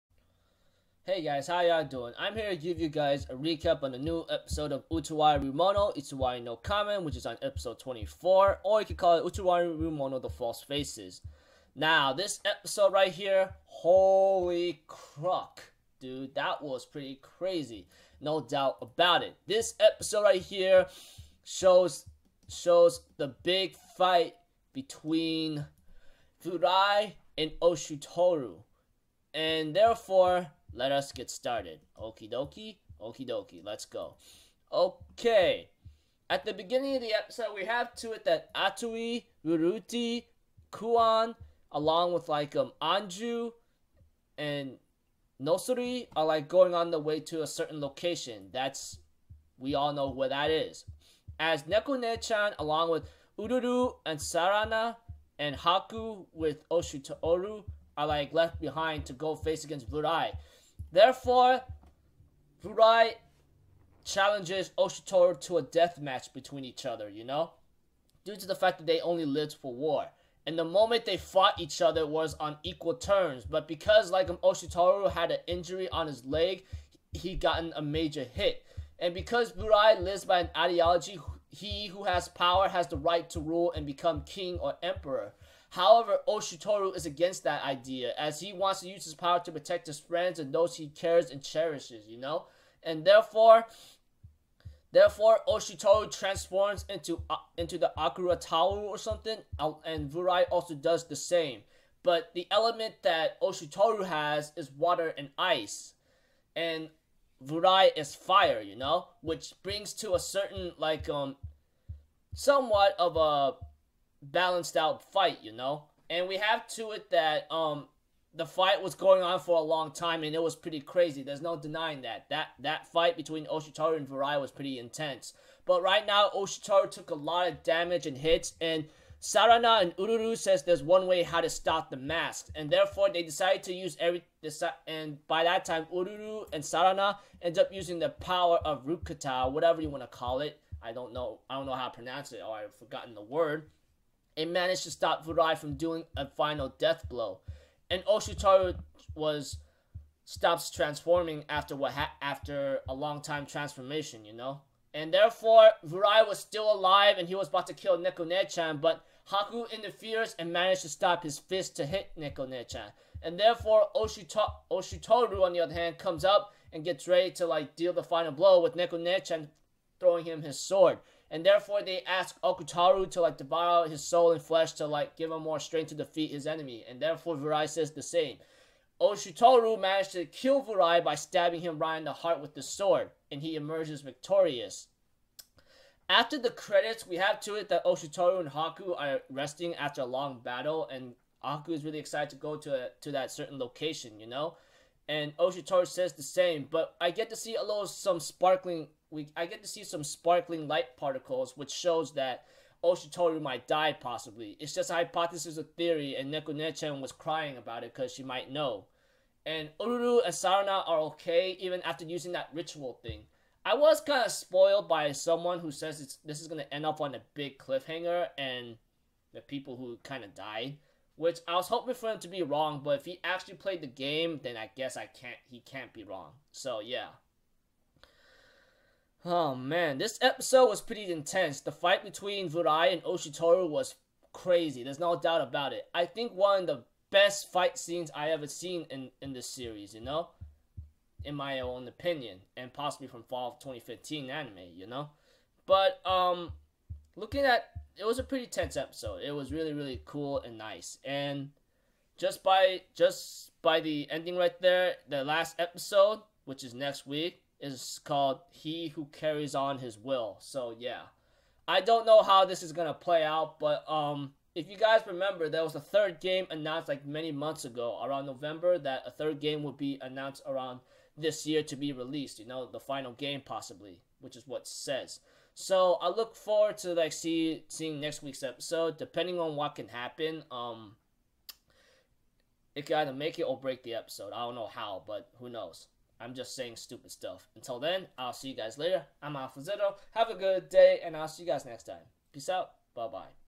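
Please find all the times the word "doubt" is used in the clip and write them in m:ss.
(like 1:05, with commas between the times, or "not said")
0:18, 3:55.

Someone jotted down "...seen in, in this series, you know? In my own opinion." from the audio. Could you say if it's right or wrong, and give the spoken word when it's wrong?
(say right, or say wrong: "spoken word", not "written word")
right.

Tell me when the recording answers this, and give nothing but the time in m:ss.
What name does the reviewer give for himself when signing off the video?
4:49.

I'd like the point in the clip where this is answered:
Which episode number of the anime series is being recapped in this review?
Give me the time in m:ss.
0:07.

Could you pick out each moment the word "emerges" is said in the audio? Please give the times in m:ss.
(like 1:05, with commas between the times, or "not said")
3:03.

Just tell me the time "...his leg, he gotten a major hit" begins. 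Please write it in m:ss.
1:16.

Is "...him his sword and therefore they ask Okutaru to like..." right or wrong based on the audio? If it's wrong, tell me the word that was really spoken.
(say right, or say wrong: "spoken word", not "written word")
right.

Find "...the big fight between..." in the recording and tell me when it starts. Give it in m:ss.
0:23.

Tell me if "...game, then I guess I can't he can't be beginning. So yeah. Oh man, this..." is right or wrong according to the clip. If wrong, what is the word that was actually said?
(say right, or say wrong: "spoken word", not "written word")
wrong: "wrong", not "beginning".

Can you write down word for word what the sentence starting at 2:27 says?
And Oshutoru was stops transforming after what ha- after a long time transformation, you know.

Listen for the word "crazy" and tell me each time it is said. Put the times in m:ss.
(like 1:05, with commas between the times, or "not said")
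0:17, 2:00, 3:54.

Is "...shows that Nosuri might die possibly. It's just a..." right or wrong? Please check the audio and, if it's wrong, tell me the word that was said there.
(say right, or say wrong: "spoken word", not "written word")
wrong: "Oshutoru", not "Nosuri".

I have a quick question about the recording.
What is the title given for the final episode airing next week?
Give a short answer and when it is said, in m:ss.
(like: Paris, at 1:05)
He Who Carries On His Will, at 4:18.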